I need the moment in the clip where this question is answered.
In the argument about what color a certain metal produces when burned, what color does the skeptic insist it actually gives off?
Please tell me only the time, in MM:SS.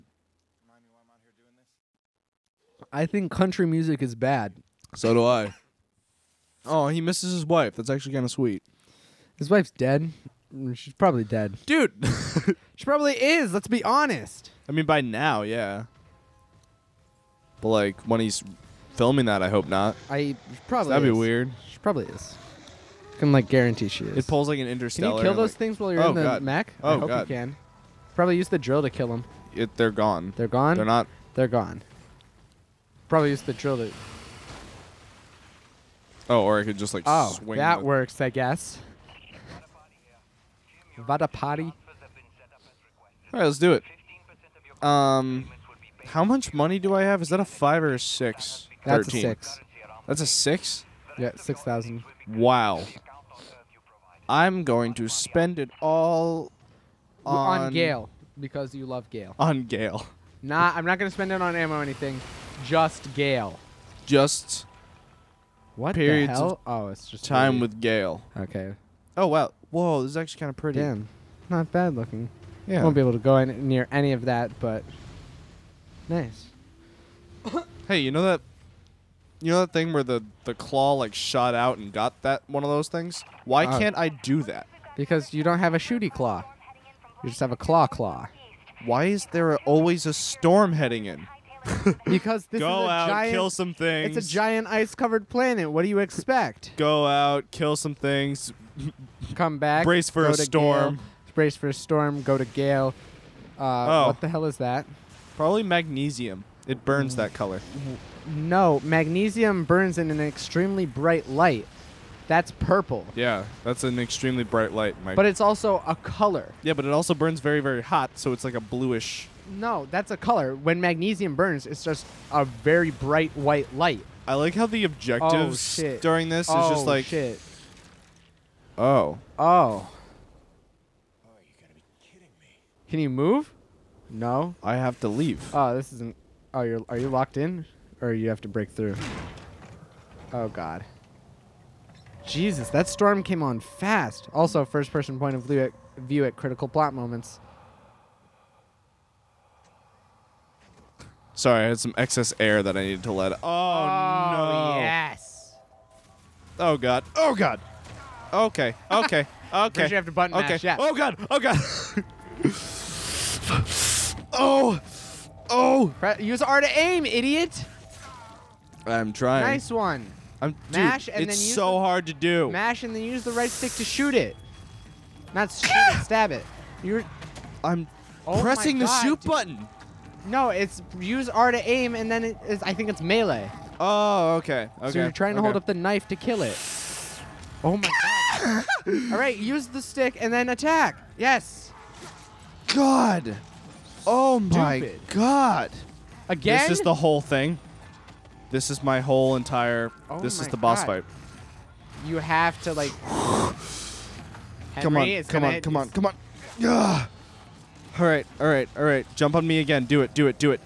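02:03.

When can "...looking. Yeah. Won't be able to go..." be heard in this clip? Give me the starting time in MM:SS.
01:11.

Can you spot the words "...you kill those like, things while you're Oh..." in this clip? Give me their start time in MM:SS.
00:24.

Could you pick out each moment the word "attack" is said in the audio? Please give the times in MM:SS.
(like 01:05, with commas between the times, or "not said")
03:10.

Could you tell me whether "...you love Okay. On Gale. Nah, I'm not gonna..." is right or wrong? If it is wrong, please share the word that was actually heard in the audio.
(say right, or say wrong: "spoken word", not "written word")
wrong: "Gale", not "Okay".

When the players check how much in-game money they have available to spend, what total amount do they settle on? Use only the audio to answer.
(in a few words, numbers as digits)
6000.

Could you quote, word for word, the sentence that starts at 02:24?
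Also, first-person point of view at, view at critical plot moments.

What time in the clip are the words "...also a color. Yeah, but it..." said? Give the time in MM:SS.
01:55.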